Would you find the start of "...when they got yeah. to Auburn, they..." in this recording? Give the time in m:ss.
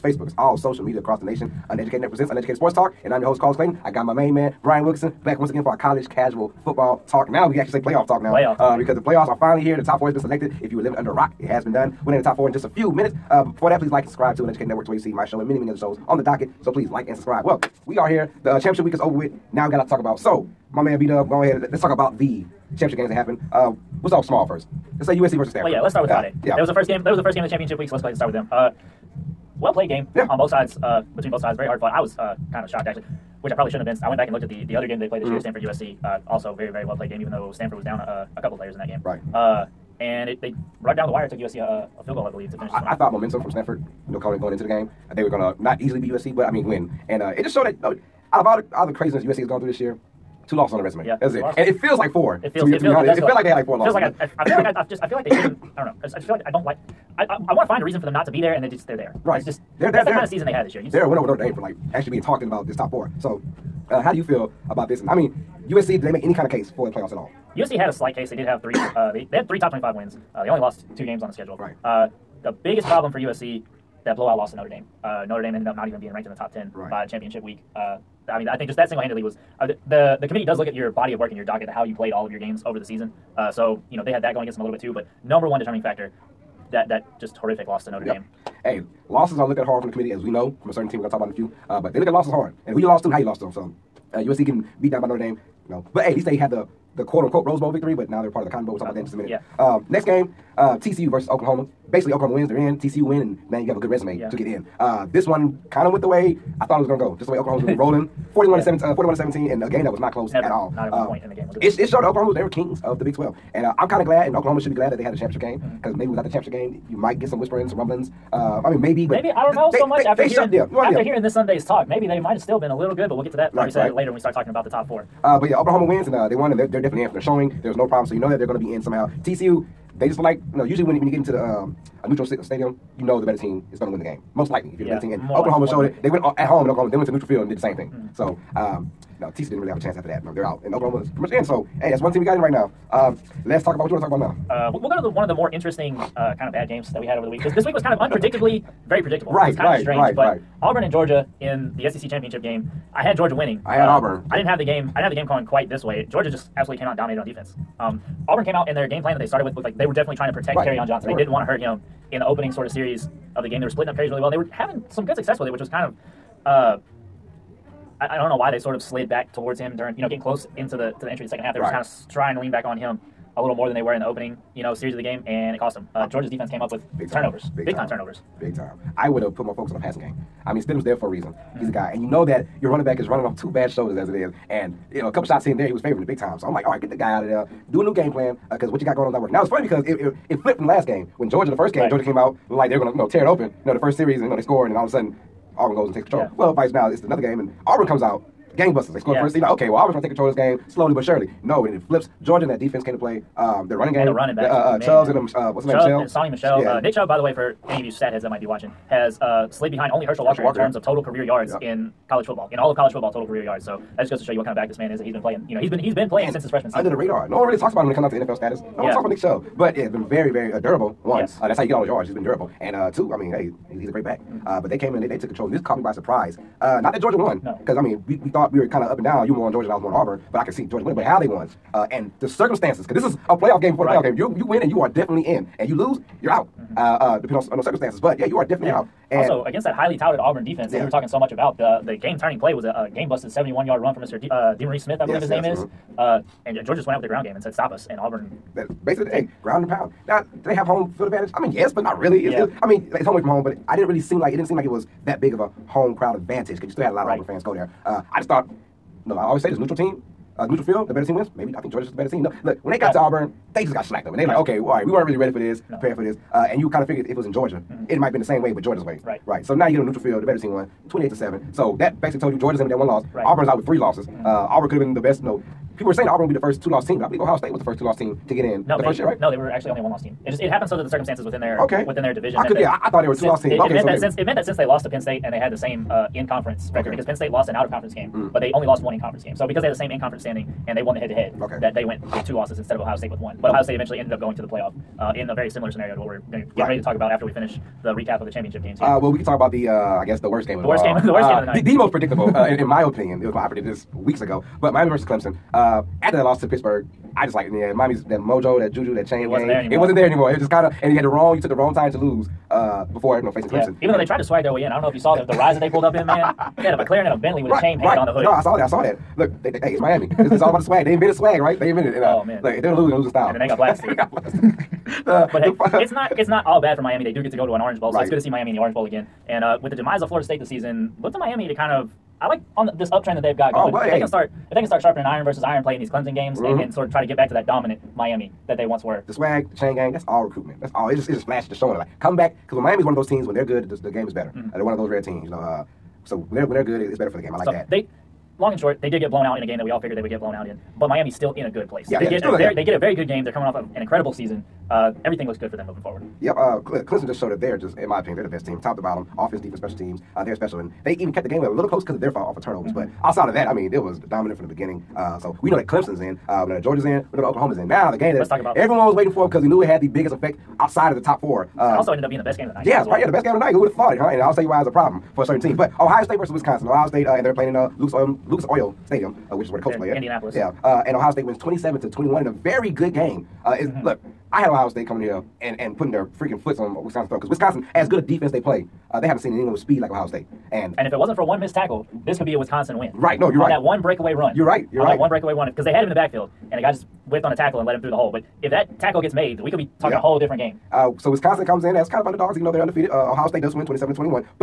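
4:22.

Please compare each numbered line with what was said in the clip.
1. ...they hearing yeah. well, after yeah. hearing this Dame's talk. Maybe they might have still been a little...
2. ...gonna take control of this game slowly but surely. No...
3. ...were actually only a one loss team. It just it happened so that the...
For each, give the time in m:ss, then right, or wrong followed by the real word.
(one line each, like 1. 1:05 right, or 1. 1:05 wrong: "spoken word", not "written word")
1. 2:00 wrong: "Sunday", not "Dame"
2. 3:19 right
3. 4:39 right.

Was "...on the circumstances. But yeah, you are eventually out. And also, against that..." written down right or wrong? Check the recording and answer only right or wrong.
wrong.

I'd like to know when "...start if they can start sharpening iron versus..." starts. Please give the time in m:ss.
5:34.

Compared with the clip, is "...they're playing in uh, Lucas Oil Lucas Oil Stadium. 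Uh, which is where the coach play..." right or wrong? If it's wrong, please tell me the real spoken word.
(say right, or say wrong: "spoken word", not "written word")
right.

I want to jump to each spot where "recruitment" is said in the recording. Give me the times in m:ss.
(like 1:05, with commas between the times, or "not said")
5:40.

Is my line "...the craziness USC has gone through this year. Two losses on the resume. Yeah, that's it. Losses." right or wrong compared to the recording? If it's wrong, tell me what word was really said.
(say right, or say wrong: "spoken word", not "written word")
right.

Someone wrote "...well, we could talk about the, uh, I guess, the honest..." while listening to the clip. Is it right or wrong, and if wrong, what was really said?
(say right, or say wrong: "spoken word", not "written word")
wrong: "worst", not "honest".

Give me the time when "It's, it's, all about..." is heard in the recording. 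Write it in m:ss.
5:20.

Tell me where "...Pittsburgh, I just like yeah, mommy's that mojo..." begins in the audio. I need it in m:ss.
5:06.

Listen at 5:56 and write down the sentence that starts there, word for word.
Yep, uh, Clemson just showed that they're just, in my opinion, they're the best team, top to bottom, offense, defense, special teams.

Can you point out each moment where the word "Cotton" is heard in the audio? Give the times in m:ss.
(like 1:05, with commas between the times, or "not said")
1:38.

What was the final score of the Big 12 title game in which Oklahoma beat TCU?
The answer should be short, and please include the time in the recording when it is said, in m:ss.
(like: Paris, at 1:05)
41 to 17, at 1:48.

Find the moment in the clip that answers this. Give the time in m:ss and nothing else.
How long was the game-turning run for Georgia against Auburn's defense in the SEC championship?
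4:03.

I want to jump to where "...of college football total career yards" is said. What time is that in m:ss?
3:32.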